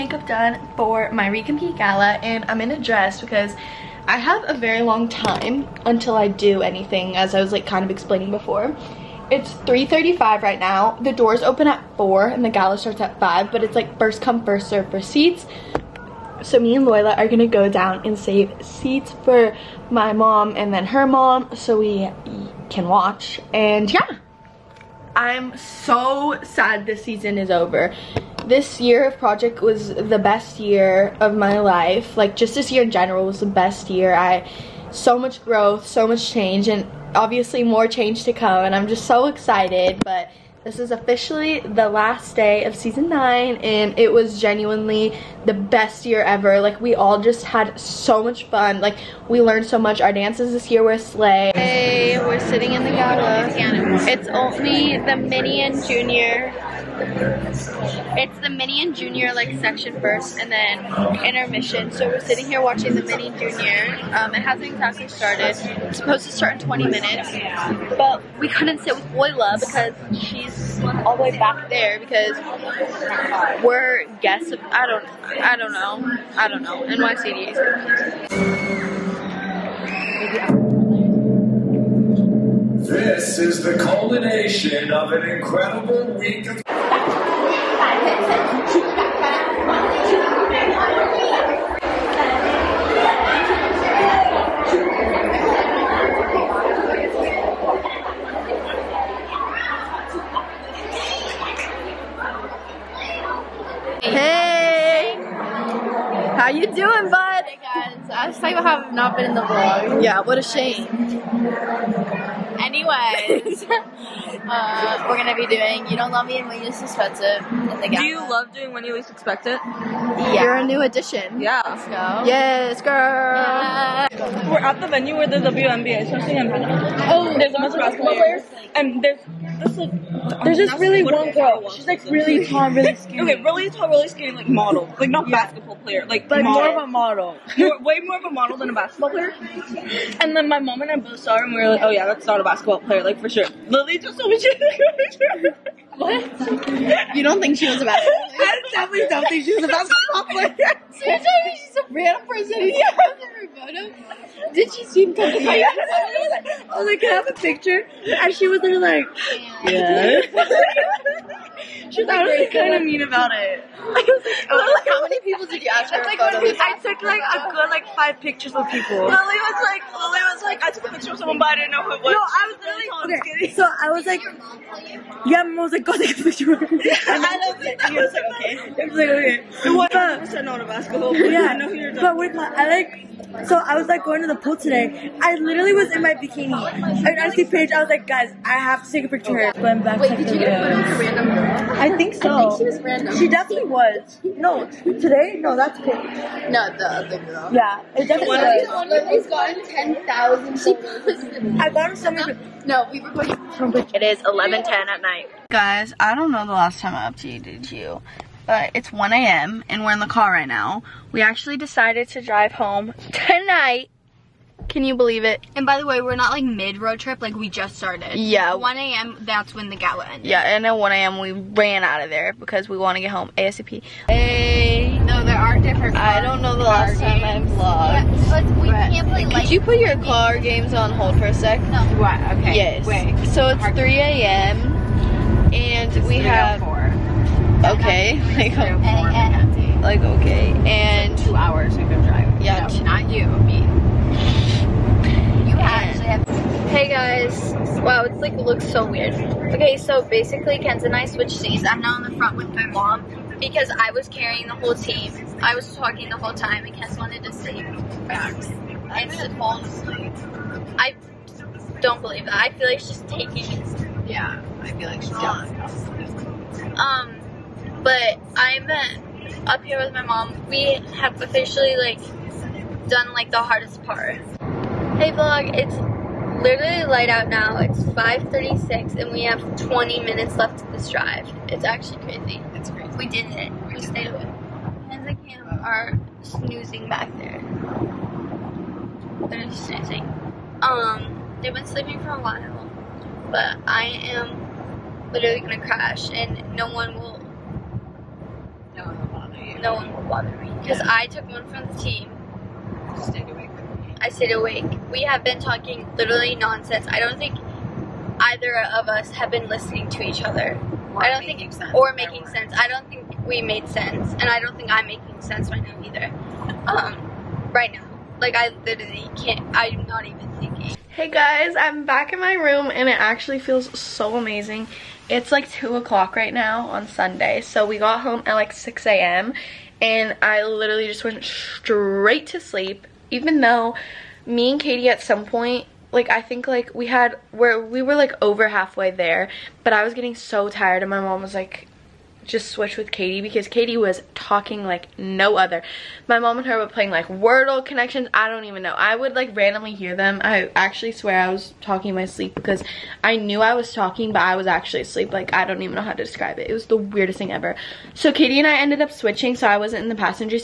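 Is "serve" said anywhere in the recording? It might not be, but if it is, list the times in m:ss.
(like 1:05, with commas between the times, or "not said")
0:14.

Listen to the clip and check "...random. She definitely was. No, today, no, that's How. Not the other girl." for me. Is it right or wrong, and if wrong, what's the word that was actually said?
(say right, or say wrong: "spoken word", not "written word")
wrong: "Paige", not "How".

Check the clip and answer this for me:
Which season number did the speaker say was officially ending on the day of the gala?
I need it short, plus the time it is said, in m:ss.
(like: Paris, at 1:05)
season 9, at 0:42.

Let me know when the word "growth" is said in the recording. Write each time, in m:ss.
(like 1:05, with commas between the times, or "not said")
0:35.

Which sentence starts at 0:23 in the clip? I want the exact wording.
And yeah, I'm so sad this season is over.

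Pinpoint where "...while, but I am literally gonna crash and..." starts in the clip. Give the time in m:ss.
4:52.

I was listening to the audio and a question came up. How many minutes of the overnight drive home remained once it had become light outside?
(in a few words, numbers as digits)
20.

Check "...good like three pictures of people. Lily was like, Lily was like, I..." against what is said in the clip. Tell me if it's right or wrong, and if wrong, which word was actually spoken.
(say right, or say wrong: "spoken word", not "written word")
wrong: "five", not "three".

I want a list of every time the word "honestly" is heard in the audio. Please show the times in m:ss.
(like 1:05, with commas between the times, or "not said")
2:42.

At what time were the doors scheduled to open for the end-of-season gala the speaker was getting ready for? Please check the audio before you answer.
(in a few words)
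4.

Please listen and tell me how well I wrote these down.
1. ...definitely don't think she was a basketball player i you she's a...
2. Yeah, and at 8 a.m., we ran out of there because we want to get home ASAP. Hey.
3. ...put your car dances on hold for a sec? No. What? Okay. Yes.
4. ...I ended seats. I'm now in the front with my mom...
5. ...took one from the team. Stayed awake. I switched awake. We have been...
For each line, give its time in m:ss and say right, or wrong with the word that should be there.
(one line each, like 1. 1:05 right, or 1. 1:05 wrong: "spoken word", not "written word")
1. 2:28 right
2. 3:40 wrong: "1", not "8"
3. 3:49 wrong: "games", not "dances"
4. 4:10 wrong: "switched", not "ended"
5. 5:01 wrong: "stayed", not "switched".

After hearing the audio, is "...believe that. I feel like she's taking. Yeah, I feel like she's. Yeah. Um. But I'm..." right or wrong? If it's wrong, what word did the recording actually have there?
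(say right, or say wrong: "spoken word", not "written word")
right.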